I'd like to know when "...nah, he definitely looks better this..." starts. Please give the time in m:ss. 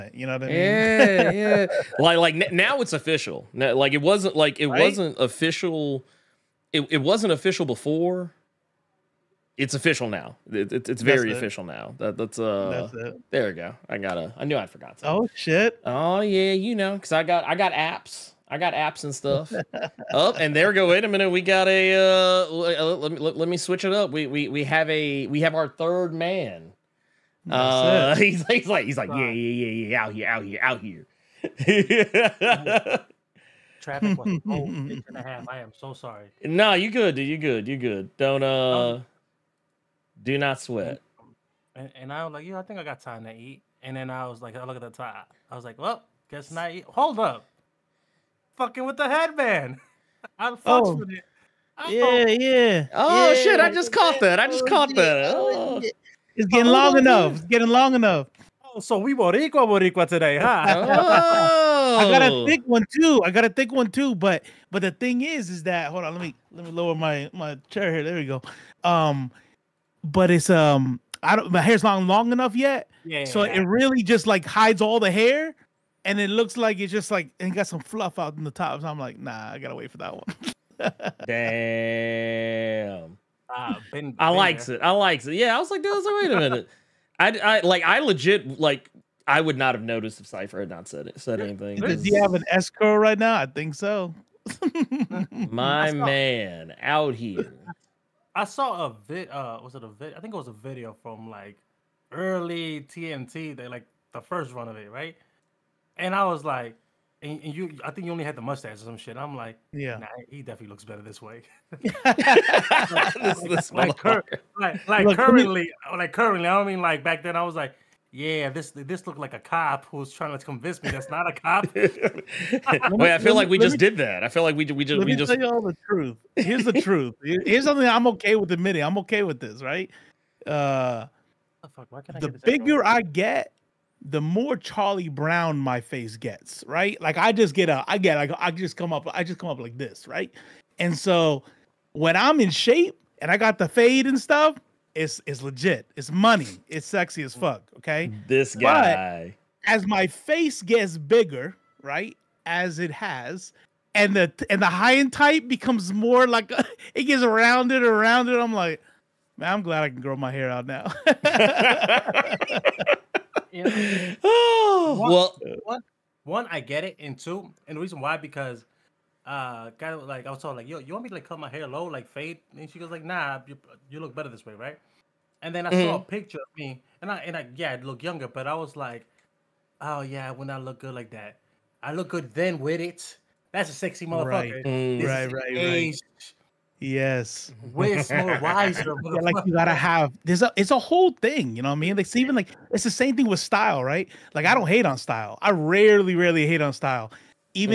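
1:49.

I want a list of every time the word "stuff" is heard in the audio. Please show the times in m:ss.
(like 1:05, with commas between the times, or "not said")
0:19, 2:24.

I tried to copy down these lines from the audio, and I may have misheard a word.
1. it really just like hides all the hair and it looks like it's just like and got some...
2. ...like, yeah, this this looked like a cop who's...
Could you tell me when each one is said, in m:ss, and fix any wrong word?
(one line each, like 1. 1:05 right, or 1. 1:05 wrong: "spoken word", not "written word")
1. 1:13 right
2. 1:57 right.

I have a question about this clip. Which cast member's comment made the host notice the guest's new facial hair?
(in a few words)
Cipher.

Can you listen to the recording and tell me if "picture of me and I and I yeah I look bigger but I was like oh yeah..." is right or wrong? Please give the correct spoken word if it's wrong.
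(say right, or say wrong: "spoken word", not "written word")
wrong: "younger", not "bigger".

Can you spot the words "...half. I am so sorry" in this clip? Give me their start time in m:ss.
0:35.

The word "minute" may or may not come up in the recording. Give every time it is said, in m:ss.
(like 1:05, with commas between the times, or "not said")
0:21, 1:26.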